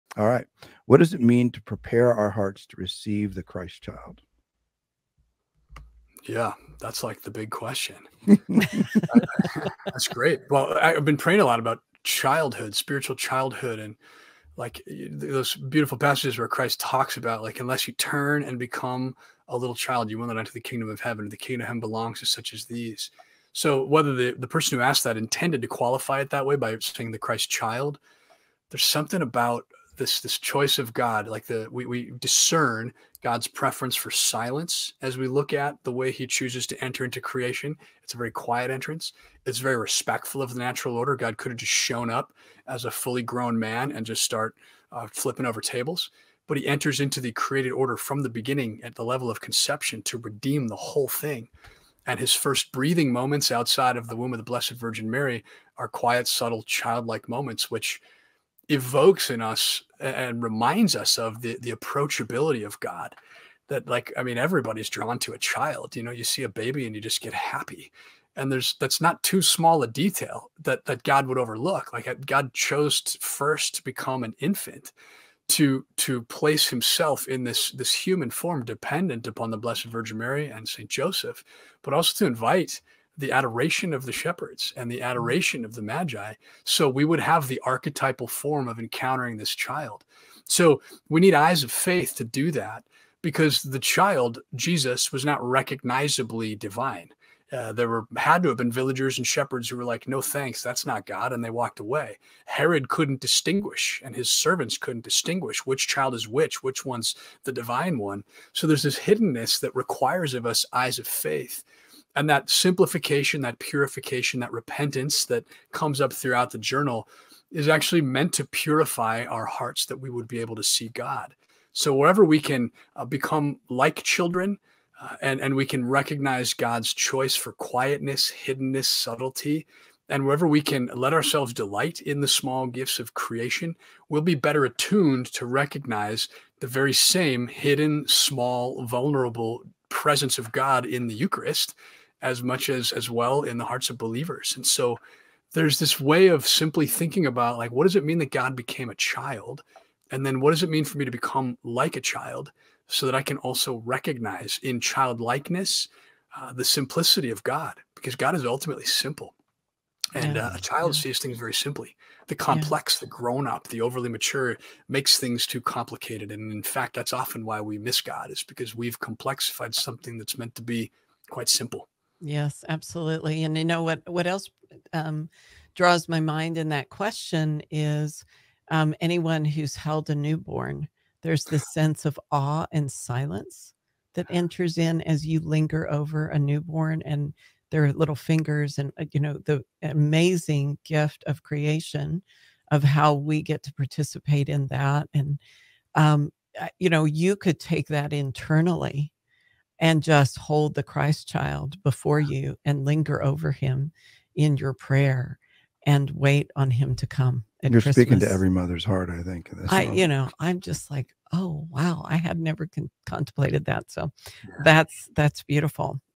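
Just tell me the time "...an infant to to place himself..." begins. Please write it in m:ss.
1:14.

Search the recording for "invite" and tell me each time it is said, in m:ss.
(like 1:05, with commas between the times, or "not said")
1:22.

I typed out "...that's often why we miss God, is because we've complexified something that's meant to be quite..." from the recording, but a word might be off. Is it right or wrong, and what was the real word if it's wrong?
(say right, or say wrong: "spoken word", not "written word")
right.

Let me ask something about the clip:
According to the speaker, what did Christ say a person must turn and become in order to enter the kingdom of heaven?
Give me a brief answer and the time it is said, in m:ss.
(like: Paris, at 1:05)
a little child, at 0:19.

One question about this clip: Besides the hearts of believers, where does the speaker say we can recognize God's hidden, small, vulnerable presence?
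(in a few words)
the Eucharist.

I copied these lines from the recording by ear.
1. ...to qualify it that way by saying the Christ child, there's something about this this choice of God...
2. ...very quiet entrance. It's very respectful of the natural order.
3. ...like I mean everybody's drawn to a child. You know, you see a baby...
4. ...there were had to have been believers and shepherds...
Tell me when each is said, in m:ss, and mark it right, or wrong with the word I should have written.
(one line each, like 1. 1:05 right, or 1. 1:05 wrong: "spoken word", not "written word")
1. 0:25 right
2. 0:38 right
3. 1:03 right
4. 1:37 wrong: "villagers", not "believers".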